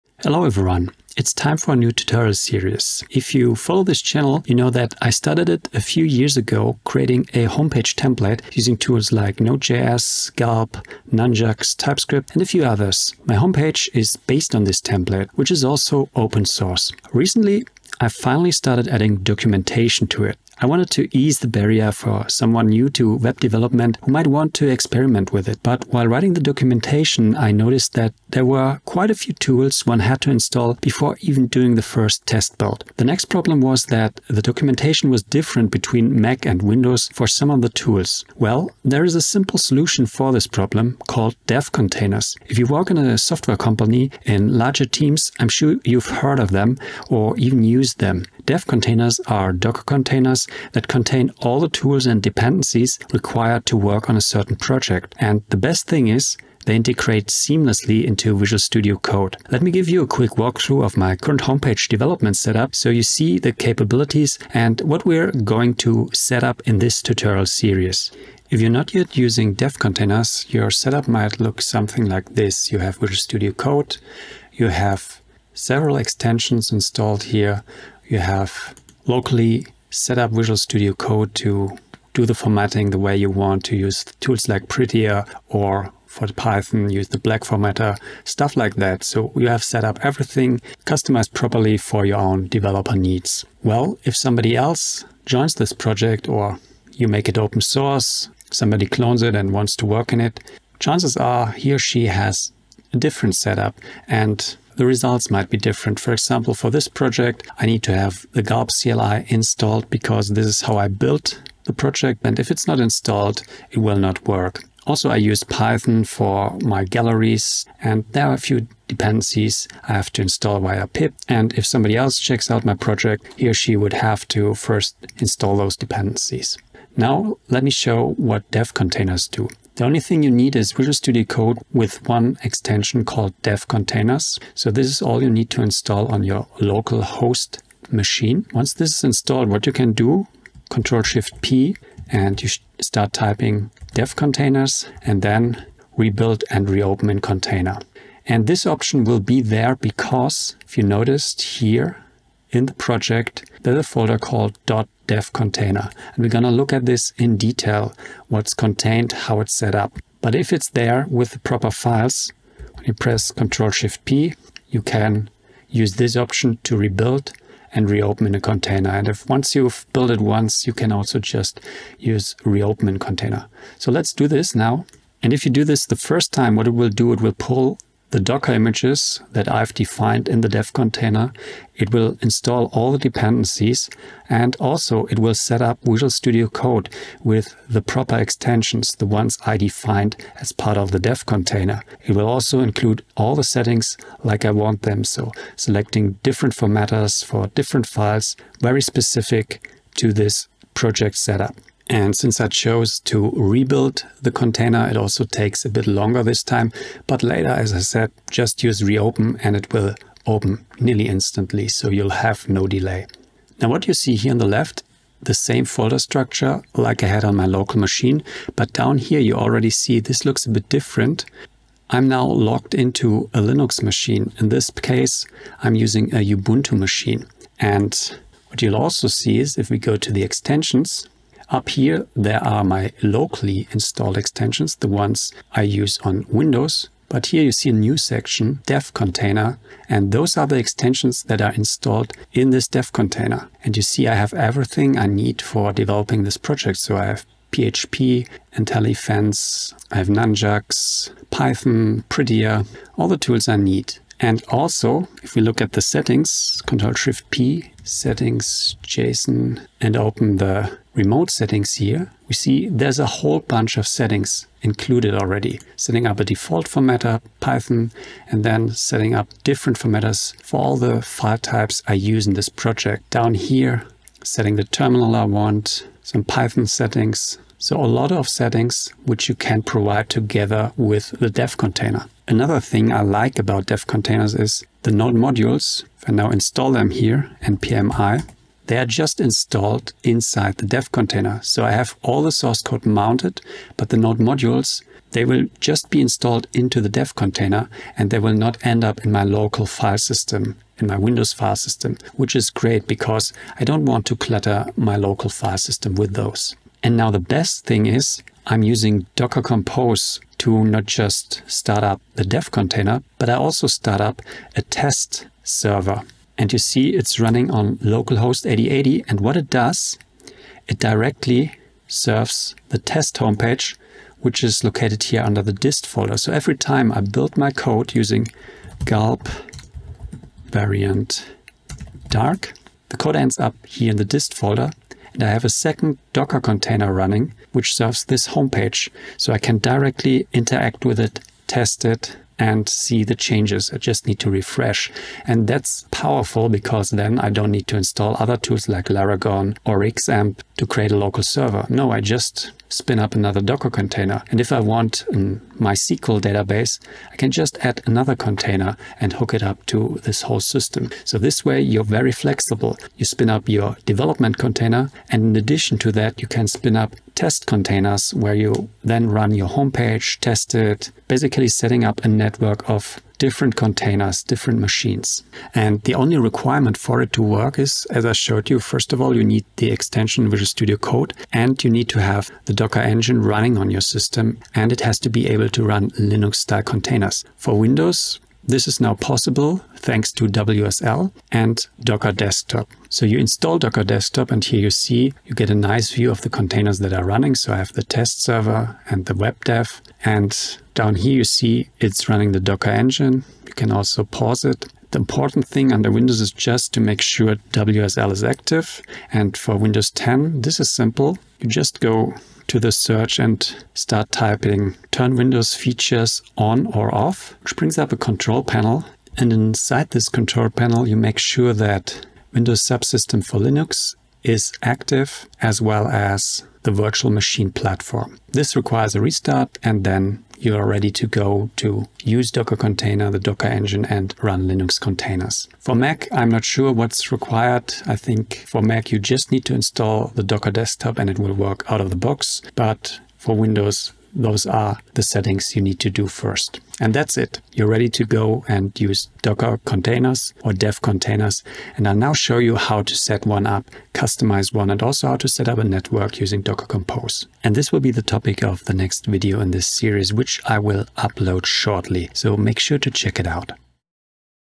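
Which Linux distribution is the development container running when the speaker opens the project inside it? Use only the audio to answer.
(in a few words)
Ubuntu.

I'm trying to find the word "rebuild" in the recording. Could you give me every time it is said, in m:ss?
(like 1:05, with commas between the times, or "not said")
2:25, 2:46, 3:23.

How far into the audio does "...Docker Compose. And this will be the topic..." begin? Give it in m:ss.
7:36.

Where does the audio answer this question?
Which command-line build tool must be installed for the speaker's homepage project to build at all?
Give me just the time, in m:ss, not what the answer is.
1:48.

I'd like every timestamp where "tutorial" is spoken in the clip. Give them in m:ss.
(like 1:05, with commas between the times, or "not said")
0:01, 1:07.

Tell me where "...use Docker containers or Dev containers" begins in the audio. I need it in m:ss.
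7:28.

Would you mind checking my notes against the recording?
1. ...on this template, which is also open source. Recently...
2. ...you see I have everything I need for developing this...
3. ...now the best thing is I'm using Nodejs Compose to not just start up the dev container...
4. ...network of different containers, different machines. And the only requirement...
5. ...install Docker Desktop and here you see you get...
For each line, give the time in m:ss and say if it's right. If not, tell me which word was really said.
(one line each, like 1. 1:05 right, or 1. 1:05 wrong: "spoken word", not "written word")
1. 0:14 right
2. 4:03 right
3. 5:06 wrong: "Docker", not "Nodejs"
4. 6:12 right
5. 6:33 right.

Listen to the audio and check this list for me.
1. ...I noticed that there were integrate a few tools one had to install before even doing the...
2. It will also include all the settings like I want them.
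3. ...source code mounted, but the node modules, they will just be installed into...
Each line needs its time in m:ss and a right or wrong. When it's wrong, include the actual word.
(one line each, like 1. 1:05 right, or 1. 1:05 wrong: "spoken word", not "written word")
1. 0:27 wrong: "quite", not "integrate"
2. 3:12 right
3. 4:52 right.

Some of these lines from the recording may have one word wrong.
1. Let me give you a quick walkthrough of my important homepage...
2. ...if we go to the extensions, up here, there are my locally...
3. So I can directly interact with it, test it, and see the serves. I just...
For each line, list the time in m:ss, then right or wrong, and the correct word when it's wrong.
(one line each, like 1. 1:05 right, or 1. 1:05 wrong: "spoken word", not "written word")
1. 0:59 wrong: "current", not "important"
2. 3:49 right
3. 5:39 wrong: "changes", not "serves".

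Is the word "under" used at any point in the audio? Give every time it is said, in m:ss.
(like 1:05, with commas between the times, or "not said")
5:25, 6:45.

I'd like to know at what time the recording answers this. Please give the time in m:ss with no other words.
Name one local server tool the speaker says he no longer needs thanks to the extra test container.
5:48.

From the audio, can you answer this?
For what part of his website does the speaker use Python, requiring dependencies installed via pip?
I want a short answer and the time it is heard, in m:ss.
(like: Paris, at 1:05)
Galleries, at 1:56.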